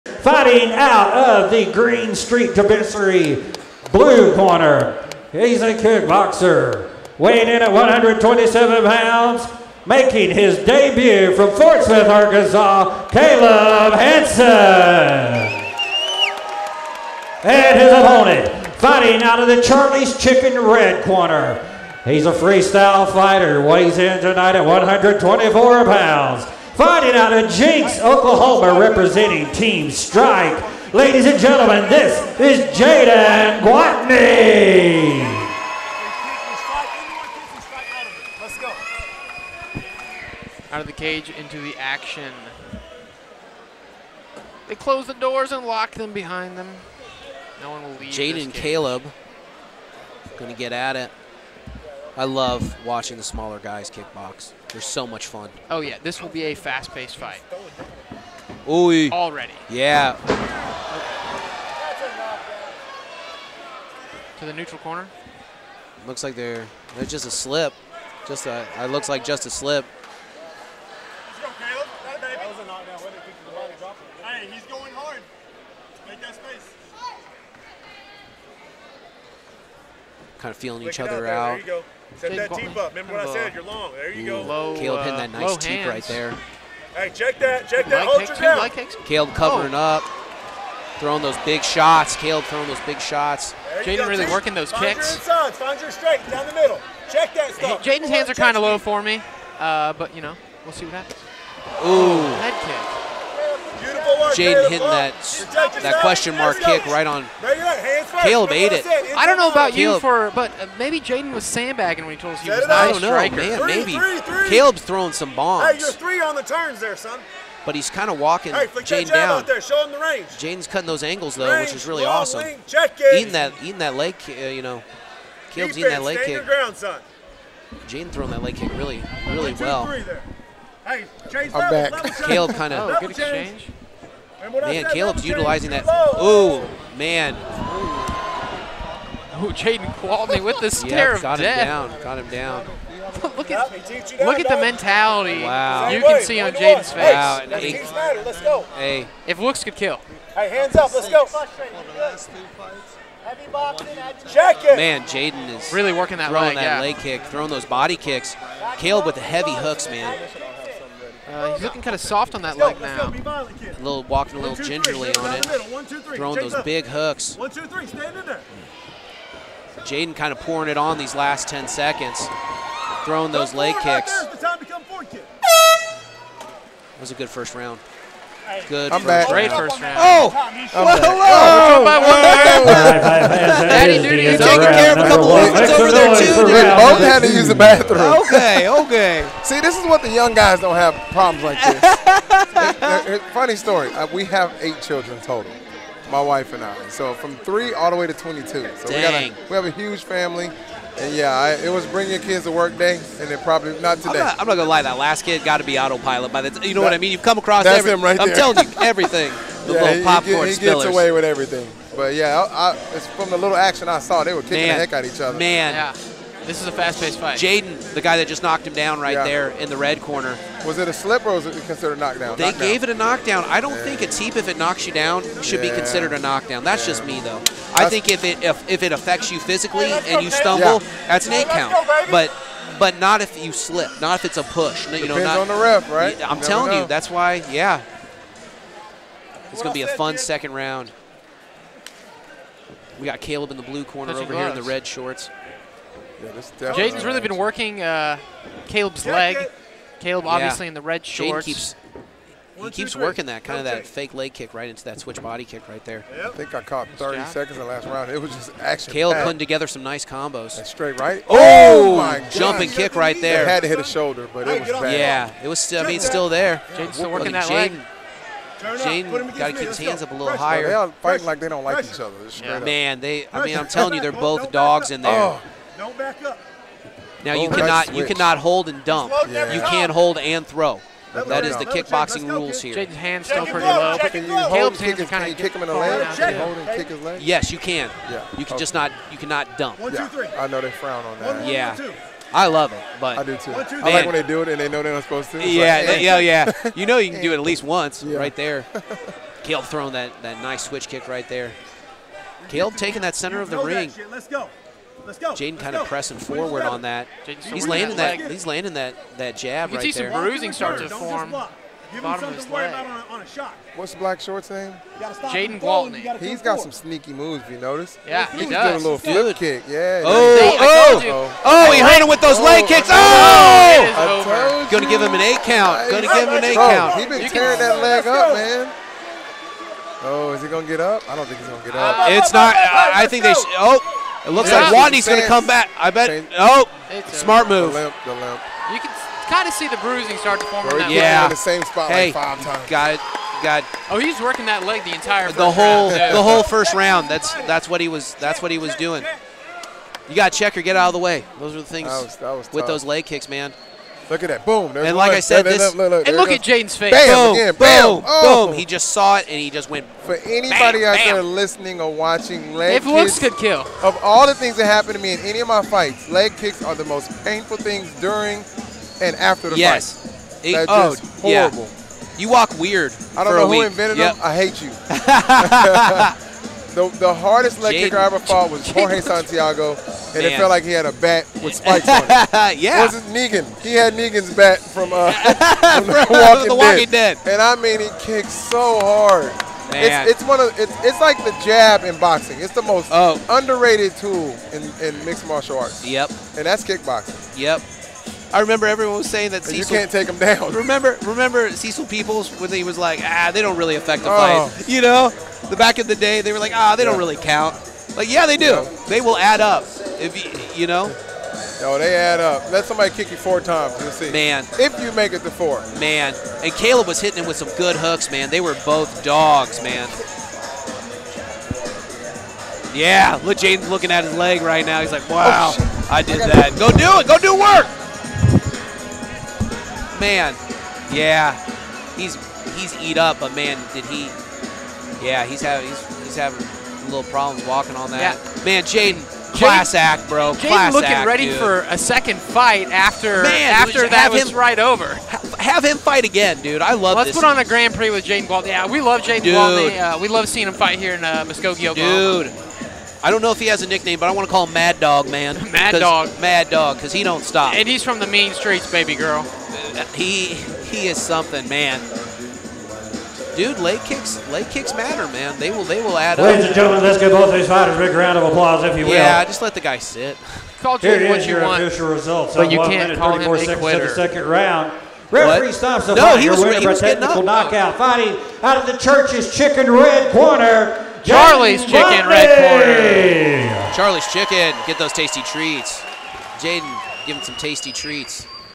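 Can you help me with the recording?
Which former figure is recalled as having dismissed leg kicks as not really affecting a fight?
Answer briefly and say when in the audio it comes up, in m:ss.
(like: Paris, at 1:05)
Cecil Peoples, at 6:41.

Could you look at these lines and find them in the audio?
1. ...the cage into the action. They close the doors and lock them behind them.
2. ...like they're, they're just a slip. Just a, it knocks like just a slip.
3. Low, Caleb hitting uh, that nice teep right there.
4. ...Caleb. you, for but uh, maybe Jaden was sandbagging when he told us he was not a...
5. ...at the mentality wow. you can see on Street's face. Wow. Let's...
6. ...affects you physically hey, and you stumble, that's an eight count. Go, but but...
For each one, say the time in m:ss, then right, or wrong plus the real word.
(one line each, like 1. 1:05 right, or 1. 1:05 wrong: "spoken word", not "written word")
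1. 0:40 right
2. 1:06 wrong: "looks", not "knocks"
3. 1:24 right
4. 1:49 right
5. 2:24 wrong: "Jaden", not "Street"
6. 3:48 right.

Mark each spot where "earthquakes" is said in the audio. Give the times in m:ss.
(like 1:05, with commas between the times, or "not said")
not said.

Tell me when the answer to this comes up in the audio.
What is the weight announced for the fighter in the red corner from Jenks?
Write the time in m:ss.
0:24.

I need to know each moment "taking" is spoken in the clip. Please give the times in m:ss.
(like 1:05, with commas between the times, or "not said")
3:04, 5:02.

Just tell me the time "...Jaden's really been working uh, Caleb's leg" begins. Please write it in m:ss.
4:06.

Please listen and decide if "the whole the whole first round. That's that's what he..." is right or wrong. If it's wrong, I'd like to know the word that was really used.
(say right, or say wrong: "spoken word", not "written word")
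right.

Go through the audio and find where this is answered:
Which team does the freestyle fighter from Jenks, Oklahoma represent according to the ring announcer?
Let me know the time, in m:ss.
0:29.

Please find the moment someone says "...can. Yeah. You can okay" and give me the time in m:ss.
4:47.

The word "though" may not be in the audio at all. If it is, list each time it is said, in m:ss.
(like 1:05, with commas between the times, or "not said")
2:01, 3:47.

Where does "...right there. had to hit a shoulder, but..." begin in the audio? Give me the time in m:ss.
4:22.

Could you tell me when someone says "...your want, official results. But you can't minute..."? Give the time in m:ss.
7:50.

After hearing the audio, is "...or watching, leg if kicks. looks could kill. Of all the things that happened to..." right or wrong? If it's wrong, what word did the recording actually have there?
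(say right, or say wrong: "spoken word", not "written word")
right.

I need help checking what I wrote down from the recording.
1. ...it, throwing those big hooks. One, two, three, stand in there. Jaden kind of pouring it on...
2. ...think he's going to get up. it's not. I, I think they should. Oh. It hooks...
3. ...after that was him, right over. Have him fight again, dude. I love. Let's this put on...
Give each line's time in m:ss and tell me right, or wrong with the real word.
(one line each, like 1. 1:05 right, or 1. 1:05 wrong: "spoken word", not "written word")
1. 2:45 right
2. 5:31 wrong: "looks", not "hooks"
3. 7:23 right.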